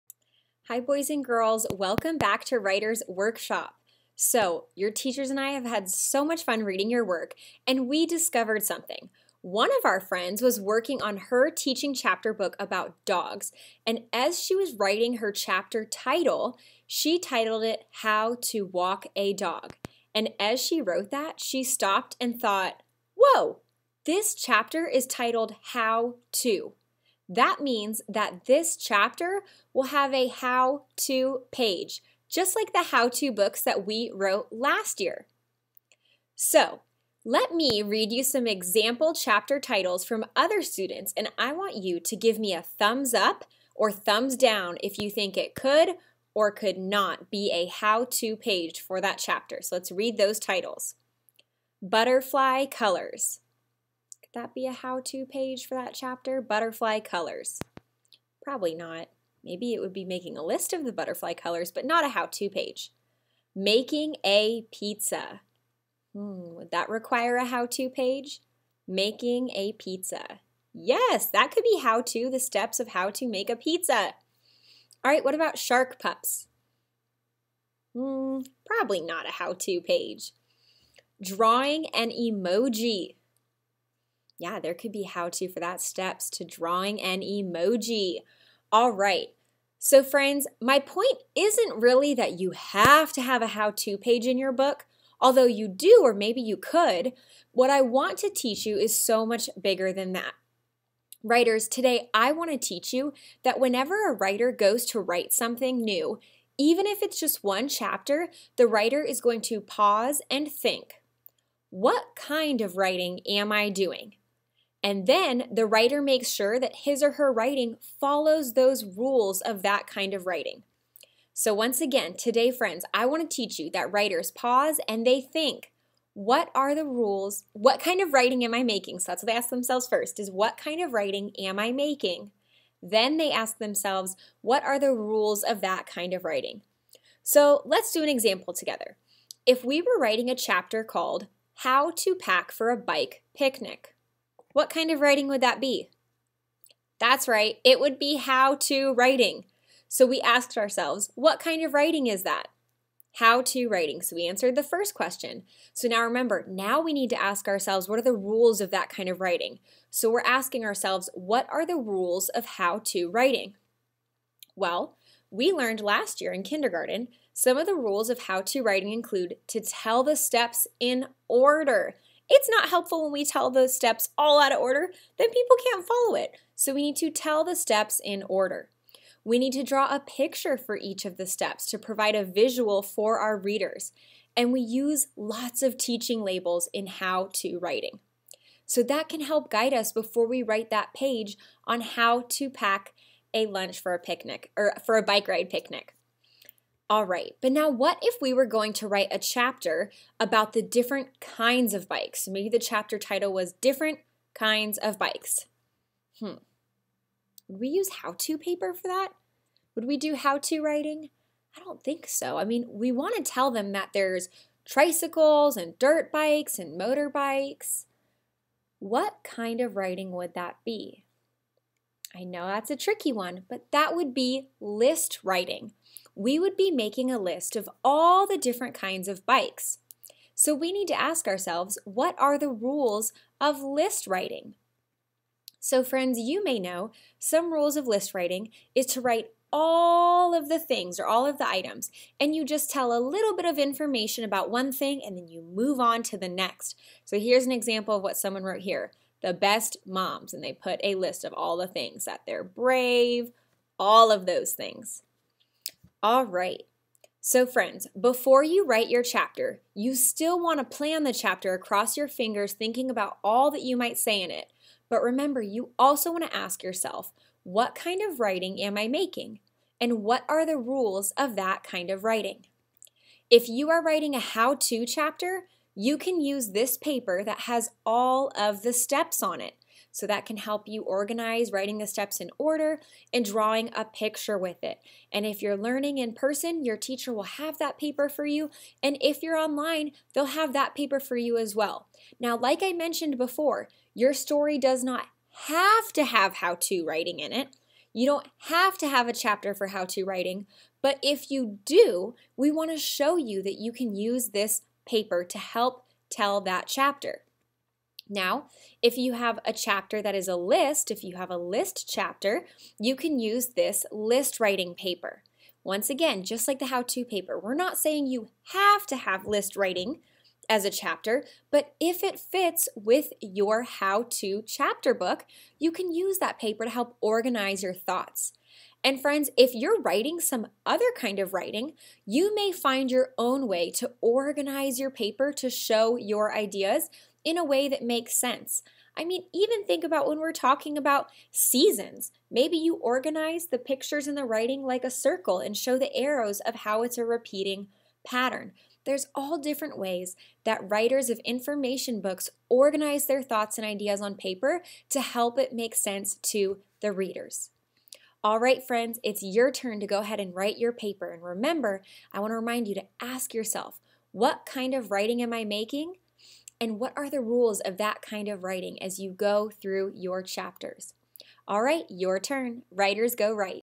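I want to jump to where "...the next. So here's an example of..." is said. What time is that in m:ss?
4:06.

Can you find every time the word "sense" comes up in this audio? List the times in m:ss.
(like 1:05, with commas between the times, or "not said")
5:38, 5:55.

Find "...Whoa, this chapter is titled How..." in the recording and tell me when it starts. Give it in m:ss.
0:23.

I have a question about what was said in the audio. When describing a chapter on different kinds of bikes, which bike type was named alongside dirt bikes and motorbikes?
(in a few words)
Tricycles.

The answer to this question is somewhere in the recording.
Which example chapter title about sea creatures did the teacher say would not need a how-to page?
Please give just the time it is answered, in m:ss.
1:15.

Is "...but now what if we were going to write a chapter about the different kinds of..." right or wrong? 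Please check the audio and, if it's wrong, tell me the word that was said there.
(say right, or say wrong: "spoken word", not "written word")
right.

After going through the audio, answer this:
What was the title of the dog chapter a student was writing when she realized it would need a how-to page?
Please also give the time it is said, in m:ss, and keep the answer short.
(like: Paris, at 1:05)
How to Walk a Dog, at 0:17.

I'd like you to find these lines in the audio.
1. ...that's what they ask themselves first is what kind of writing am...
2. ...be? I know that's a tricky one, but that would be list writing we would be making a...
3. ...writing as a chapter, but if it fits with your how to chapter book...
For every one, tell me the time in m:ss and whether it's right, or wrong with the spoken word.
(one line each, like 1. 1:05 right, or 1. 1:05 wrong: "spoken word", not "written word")
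1. 2:09 right
2. 3:40 right
3. 5:19 right.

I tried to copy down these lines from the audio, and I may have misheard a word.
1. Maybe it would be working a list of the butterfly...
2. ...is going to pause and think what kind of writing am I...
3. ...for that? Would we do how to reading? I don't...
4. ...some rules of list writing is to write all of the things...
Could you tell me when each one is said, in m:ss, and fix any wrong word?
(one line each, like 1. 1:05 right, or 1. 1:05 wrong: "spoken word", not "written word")
1. 0:59 wrong: "making", not "working"
2. 1:49 right
3. 3:28 wrong: "writing", not "reading"
4. 3:57 right.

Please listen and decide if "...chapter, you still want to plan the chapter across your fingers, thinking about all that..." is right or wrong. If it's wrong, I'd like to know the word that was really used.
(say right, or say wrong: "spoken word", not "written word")
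right.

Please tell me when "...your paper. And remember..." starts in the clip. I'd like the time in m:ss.
6:00.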